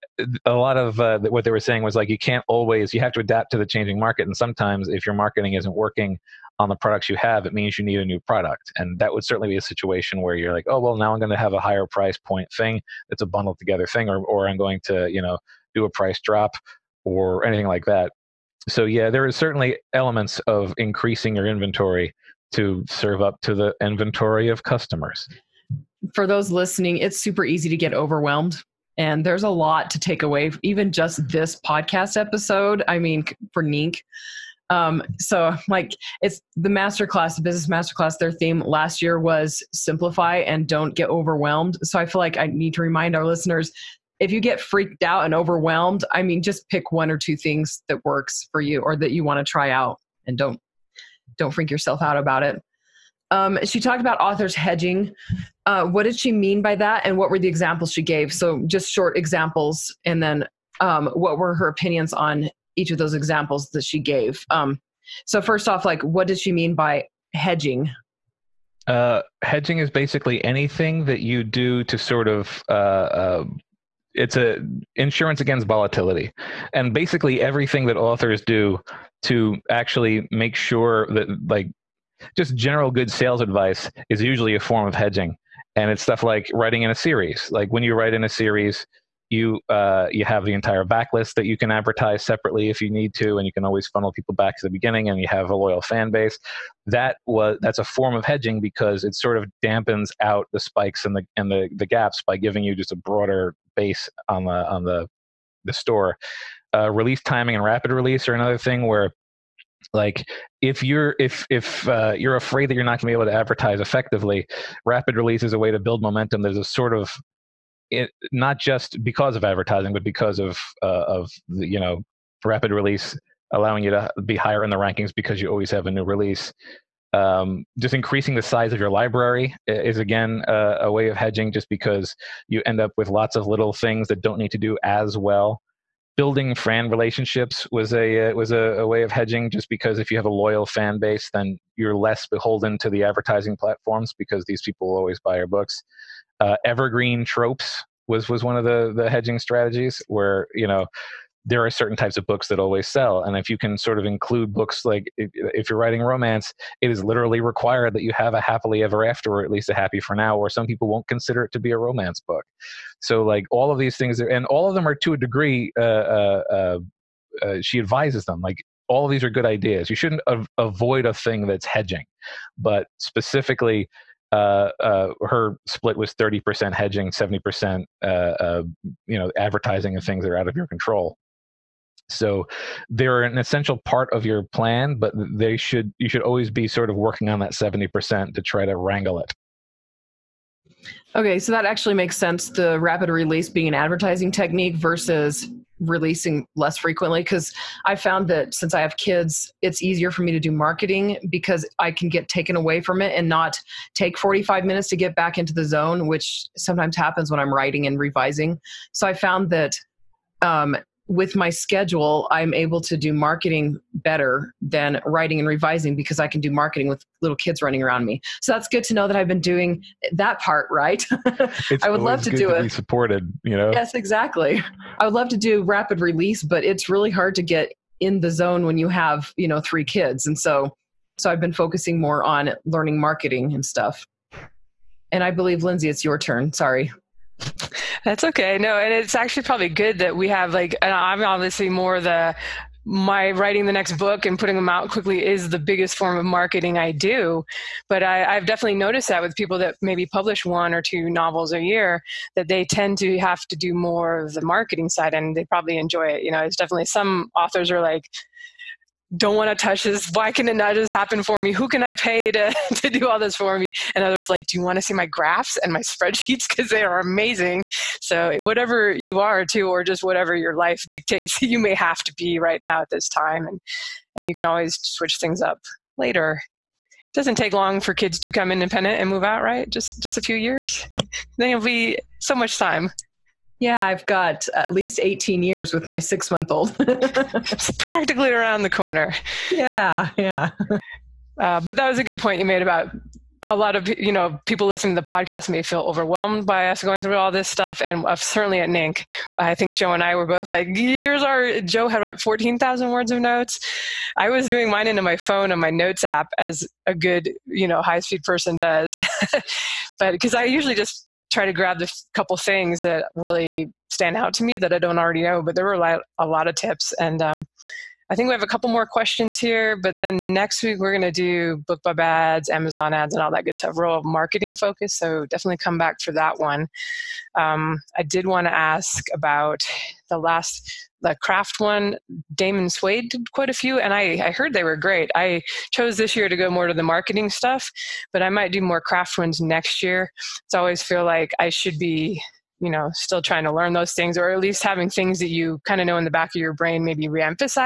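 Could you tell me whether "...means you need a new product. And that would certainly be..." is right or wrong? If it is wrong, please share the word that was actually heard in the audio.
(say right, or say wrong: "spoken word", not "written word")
right.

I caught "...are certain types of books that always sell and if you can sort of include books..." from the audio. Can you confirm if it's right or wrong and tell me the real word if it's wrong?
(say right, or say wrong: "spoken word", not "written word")
right.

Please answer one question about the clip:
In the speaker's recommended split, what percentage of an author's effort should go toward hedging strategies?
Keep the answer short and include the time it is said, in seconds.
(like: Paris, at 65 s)
30%, at 176 s.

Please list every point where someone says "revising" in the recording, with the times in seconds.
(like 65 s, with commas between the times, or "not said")
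207 s, 215 s.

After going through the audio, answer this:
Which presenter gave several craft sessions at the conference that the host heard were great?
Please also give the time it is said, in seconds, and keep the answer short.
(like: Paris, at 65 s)
Damon Suede, at 332 s.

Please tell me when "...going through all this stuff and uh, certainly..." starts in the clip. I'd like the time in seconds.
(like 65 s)
296 s.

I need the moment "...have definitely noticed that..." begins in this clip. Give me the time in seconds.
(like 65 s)
248 s.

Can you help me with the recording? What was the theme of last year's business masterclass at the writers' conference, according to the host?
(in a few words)
simplify and don't get overwhelmed.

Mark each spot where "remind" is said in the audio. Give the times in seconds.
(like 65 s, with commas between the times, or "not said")
42 s.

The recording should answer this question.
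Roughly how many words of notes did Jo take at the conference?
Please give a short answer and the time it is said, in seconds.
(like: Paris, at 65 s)
14000, at 302 s.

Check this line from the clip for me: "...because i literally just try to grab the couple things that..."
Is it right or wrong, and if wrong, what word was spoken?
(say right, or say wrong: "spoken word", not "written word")
wrong: "usually", not "literally".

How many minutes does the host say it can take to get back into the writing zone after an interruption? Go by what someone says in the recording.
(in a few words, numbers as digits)
45.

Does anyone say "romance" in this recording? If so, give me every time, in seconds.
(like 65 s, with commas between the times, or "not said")
156 s, 161 s.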